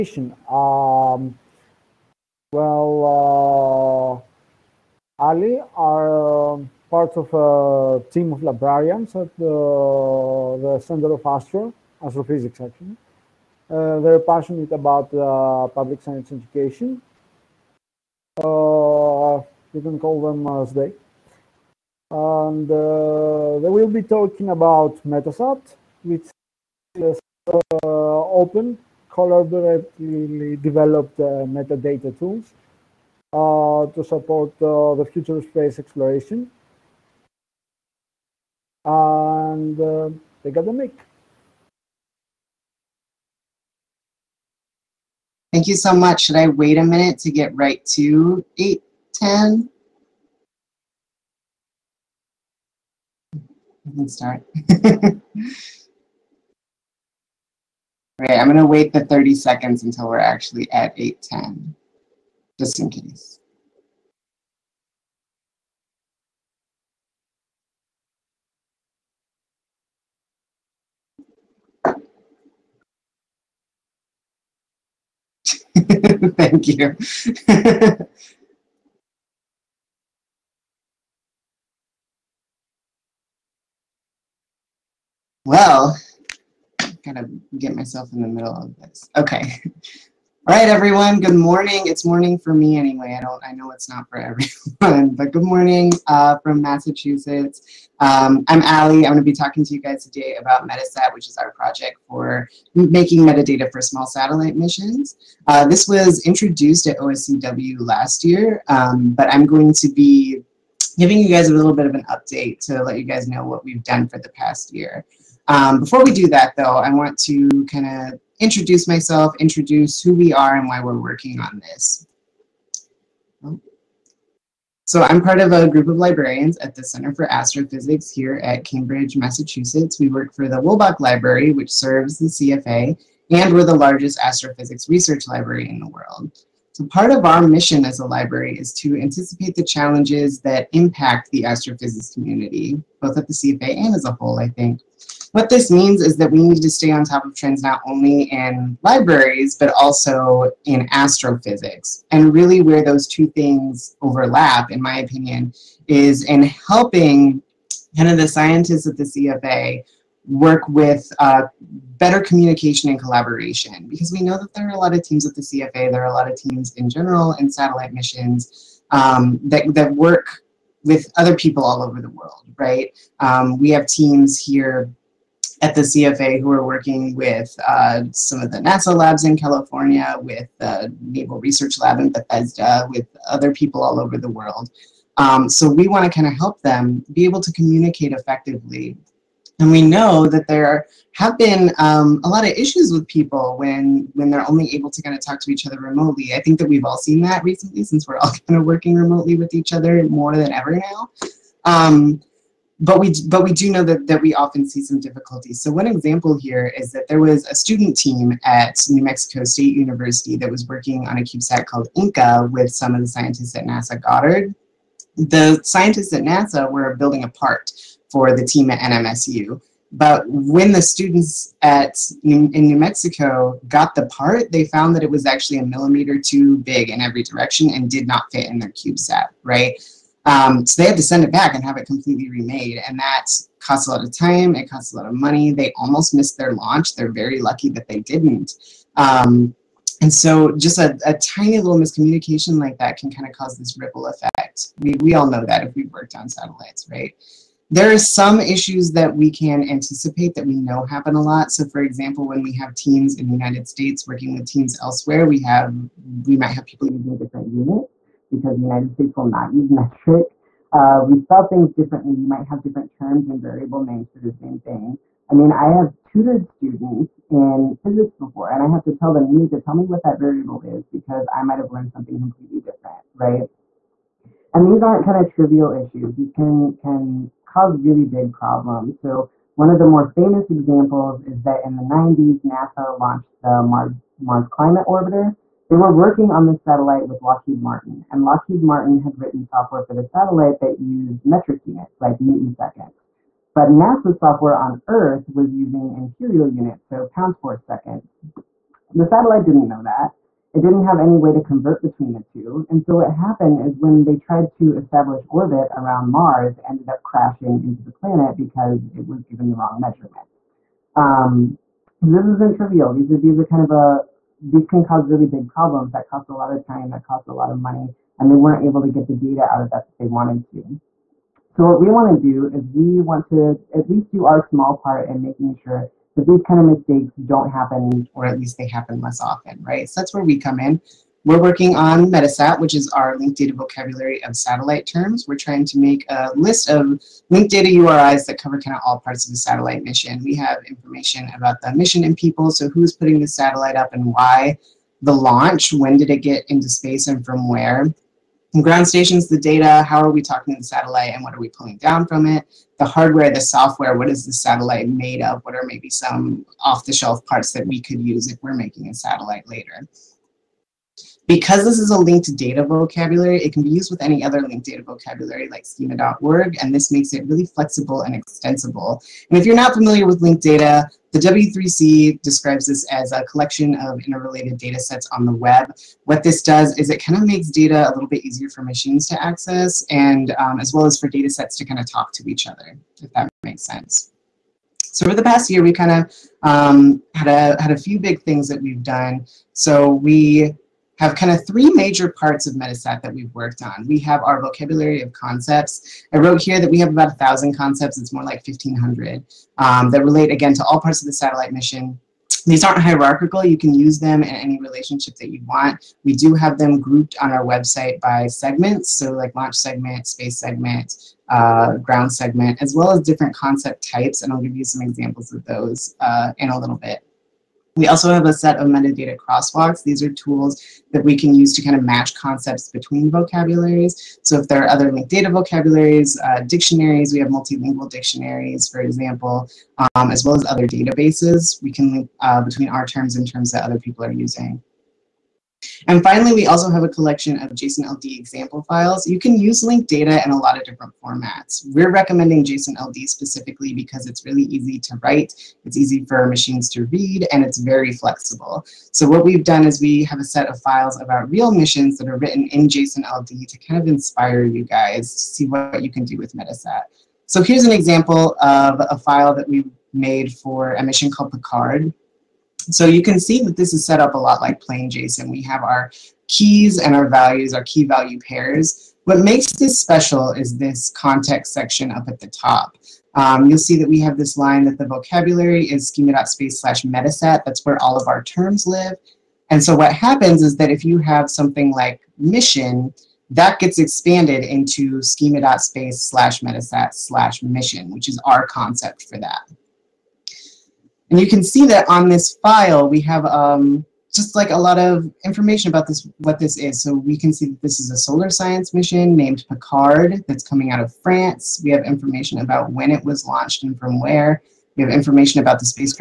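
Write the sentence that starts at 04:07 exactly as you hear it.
There are some issues that we can anticipate that we know happen a lot.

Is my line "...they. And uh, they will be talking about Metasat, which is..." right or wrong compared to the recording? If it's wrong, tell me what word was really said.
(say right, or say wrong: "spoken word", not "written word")
right.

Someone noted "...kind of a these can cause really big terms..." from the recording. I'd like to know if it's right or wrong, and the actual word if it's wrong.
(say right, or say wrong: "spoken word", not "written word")
wrong: "problems", not "terms".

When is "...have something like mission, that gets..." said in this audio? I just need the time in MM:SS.
08:00.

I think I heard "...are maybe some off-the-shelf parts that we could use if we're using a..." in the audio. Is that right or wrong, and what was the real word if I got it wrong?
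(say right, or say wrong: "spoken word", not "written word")
wrong: "making", not "using".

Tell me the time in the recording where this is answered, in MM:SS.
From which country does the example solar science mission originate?
08:21.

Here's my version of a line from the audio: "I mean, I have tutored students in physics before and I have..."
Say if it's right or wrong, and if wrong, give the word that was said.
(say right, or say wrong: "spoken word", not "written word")
right.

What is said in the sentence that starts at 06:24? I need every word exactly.
So over the past year, we kind of um, had, a, had a few big things that we've done.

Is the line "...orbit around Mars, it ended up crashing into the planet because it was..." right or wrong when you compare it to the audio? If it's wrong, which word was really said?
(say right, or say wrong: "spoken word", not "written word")
right.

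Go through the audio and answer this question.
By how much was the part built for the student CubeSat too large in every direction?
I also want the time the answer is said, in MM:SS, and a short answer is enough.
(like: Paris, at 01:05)
a millimeter, at 03:45.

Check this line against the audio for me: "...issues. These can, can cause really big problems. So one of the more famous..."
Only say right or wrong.
right.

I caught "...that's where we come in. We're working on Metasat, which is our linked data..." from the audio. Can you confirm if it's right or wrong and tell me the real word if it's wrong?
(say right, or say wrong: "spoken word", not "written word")
right.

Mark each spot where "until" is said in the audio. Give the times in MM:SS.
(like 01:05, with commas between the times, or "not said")
00:59.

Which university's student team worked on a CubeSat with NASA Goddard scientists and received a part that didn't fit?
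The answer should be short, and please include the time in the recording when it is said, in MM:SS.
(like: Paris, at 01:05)
New Mexico State University, at 03:28.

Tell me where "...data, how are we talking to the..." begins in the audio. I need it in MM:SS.
05:49.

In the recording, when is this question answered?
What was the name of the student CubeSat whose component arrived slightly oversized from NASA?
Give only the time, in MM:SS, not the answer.
03:31.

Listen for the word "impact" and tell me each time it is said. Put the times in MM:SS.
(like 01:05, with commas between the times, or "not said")
02:20.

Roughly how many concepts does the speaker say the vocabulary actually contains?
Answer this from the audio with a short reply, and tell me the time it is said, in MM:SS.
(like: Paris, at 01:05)
1,500, at 06:38.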